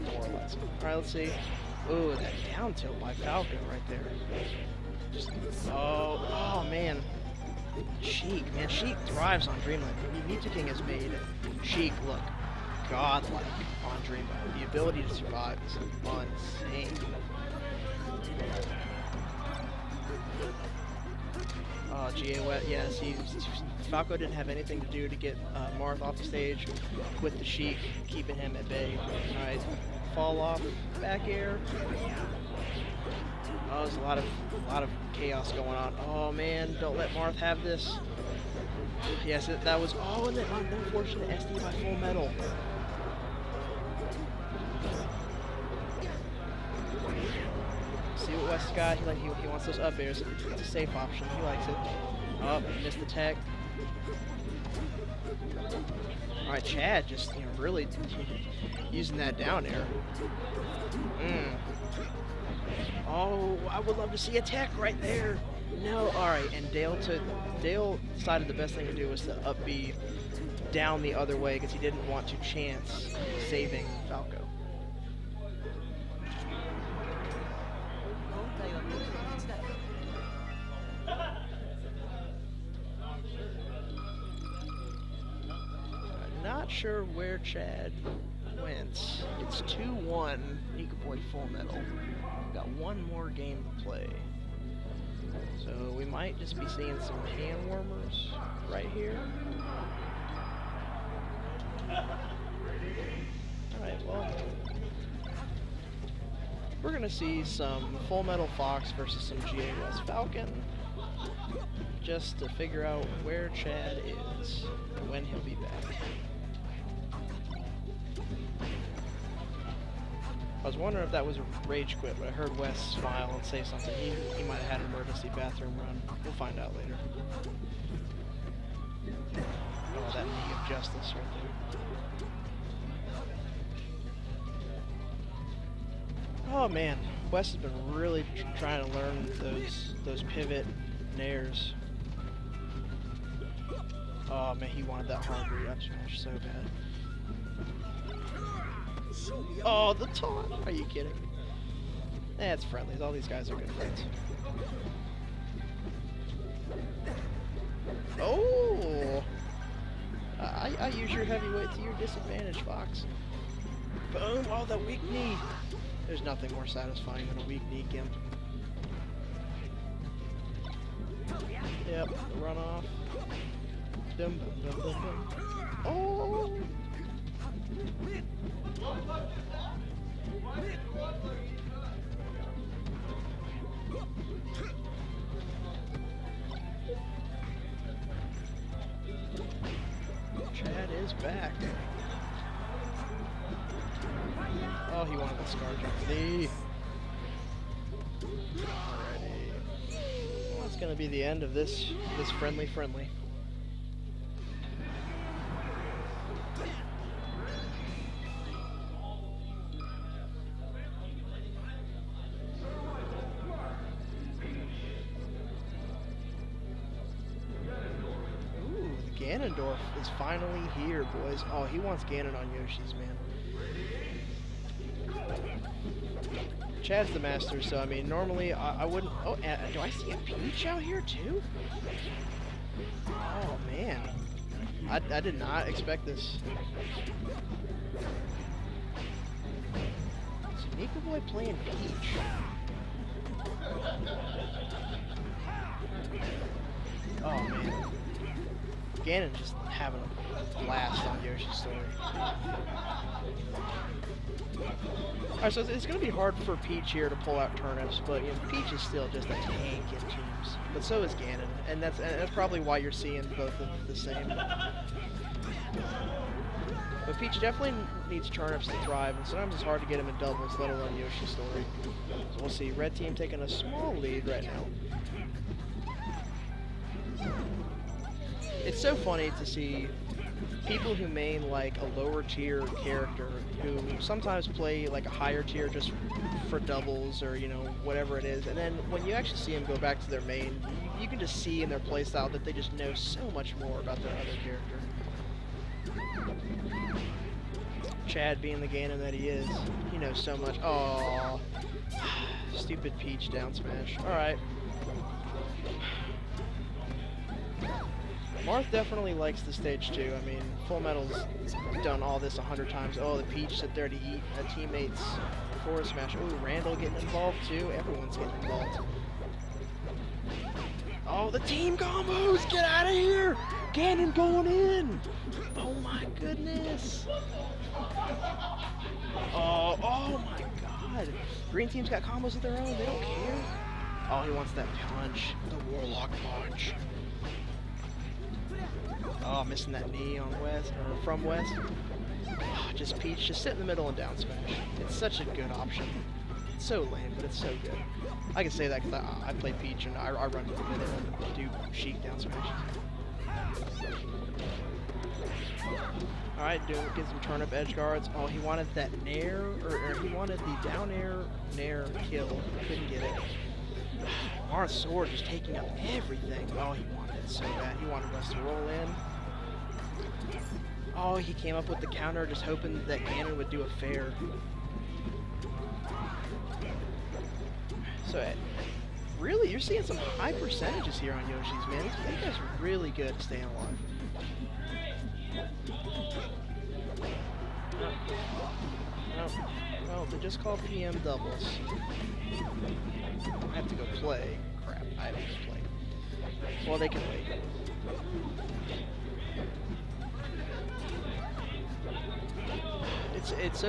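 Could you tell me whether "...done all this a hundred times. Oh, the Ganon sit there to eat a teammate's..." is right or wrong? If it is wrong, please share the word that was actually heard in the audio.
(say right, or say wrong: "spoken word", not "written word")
wrong: "Peach", not "Ganon".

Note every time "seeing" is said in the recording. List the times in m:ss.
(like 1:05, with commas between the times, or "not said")
1:36, 4:22, 6:19.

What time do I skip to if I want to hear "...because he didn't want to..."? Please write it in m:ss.
1:11.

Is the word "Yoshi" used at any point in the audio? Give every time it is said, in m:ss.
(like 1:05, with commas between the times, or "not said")
3:42, 4:11, 4:30, 6:21.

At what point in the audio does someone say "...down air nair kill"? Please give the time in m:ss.
6:00.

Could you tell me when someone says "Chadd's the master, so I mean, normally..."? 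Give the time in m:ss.
3:46.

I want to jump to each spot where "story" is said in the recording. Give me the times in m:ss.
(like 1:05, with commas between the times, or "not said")
4:11, 4:31.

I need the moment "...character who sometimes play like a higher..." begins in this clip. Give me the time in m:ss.
4:42.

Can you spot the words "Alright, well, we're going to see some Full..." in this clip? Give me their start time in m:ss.
1:43.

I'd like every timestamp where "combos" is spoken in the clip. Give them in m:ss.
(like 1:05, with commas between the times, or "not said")
5:21, 5:32.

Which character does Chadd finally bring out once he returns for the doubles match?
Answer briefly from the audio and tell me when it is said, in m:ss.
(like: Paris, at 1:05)
Ganondorf, at 3:39.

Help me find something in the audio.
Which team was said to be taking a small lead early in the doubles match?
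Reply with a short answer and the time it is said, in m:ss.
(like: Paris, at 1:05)
Red team, at 4:32.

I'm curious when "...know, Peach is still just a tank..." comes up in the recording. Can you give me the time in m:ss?
4:18.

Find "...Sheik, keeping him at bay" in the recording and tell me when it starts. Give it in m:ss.
0:27.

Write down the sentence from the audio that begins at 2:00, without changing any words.
I was wondering if that was a rage quit, but I heard Wes smile and say something.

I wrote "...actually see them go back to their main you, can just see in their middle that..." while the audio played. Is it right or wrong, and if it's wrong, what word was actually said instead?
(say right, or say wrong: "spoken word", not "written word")
wrong: "playstyle", not "middle".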